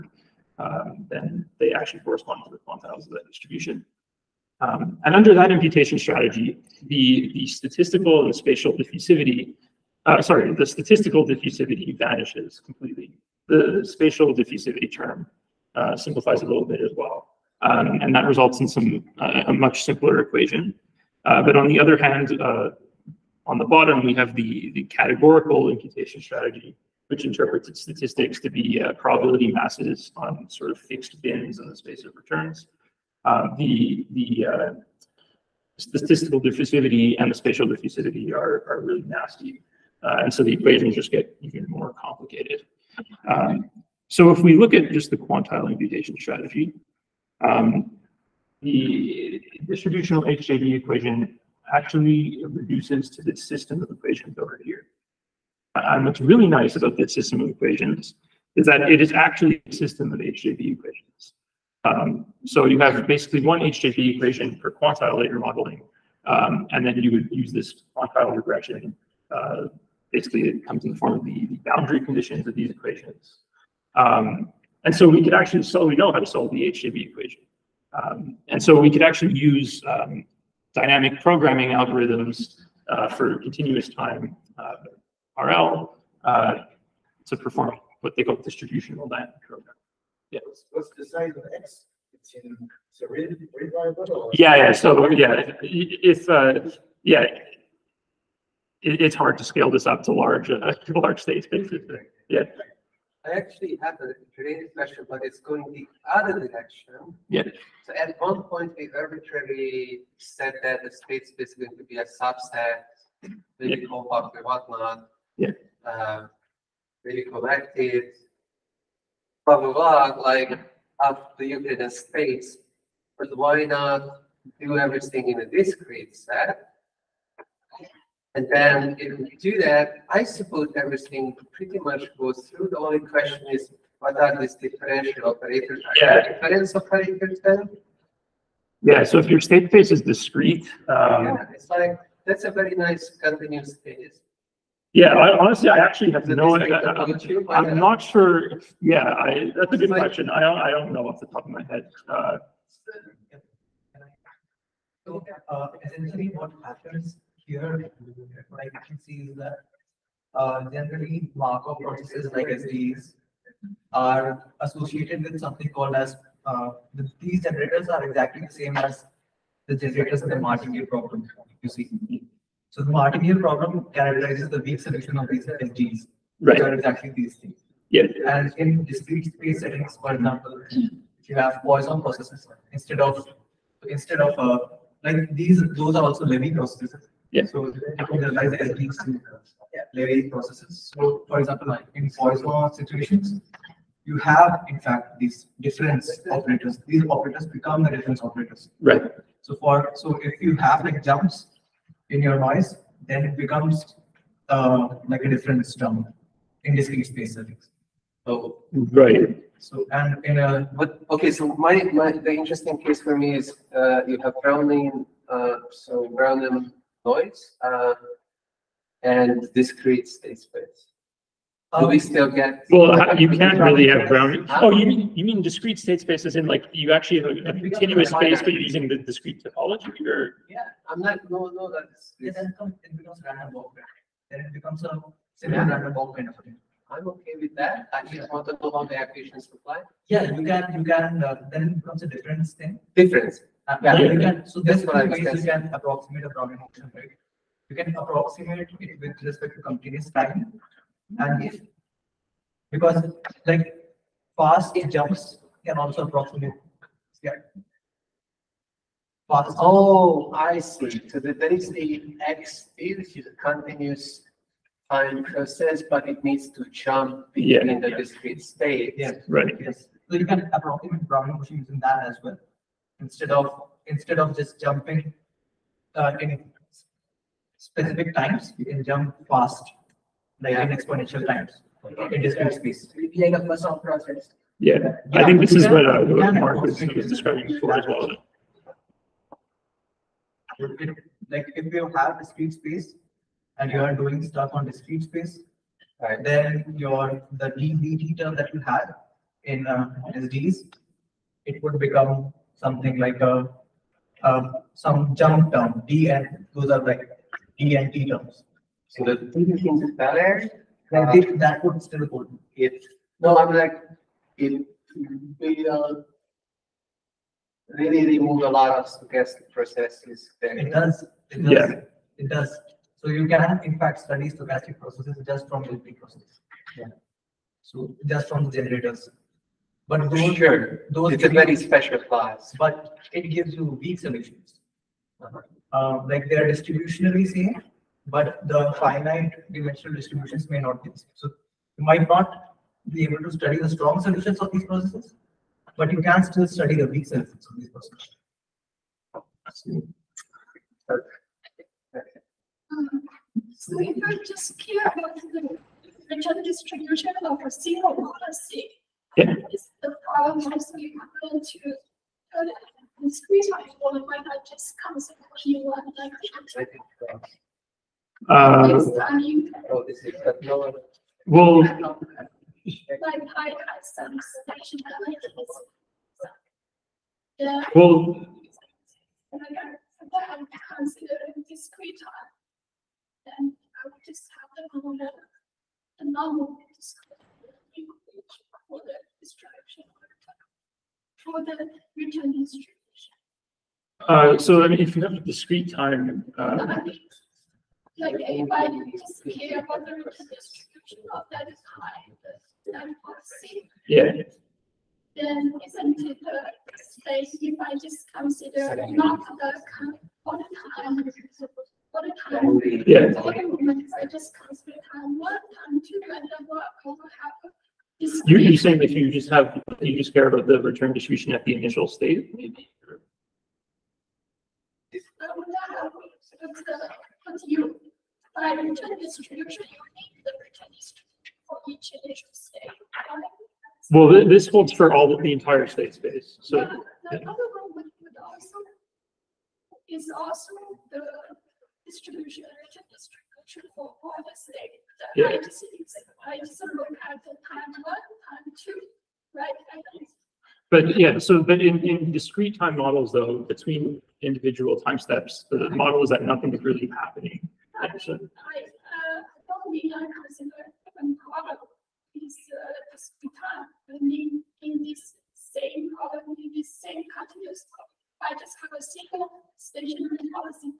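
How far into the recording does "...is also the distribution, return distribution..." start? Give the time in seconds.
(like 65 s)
439 s.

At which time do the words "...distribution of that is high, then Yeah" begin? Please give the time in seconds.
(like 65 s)
400 s.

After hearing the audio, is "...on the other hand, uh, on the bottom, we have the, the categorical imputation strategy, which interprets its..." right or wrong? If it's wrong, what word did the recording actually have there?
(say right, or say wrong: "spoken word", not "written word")
right.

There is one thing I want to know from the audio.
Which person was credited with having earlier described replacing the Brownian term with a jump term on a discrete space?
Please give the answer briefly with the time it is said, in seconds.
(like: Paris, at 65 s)
Marc, at 286 s.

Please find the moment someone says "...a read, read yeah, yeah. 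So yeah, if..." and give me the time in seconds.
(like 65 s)
93 s.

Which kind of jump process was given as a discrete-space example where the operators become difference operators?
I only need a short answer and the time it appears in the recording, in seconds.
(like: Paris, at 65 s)
Poisson processes, at 181 s.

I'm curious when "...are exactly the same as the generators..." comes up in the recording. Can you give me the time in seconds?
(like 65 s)
167 s.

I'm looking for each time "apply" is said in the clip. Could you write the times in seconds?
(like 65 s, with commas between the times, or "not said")
239 s.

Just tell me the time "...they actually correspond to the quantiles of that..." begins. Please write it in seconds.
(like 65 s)
1 s.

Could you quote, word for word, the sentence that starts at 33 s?
Um, the the uh, statistical diffusivity and the spatial diffusivity are, are really nasty.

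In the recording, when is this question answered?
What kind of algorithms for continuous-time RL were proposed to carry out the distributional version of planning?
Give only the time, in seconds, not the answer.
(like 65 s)
80 s.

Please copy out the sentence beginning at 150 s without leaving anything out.
I don't, I don't know off the top of my head.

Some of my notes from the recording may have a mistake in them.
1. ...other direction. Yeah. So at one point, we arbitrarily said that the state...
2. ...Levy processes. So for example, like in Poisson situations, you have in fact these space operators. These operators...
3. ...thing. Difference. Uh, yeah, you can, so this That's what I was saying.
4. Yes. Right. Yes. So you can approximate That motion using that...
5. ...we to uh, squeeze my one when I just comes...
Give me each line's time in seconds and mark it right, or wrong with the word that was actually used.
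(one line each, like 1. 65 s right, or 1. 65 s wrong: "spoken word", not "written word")
1. 106 s right
2. 189 s wrong: "difference", not "space"
3. 242 s right
4. 268 s wrong: "Brownian", not "That"
5. 361 s right.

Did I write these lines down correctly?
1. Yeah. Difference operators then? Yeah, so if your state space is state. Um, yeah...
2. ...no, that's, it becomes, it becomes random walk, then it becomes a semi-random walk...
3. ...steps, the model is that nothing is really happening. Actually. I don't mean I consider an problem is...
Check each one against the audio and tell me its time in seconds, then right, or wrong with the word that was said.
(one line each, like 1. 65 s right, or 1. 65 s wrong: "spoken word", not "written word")
1. 135 s wrong: "discrete", not "state"
2. 231 s right
3. 454 s right.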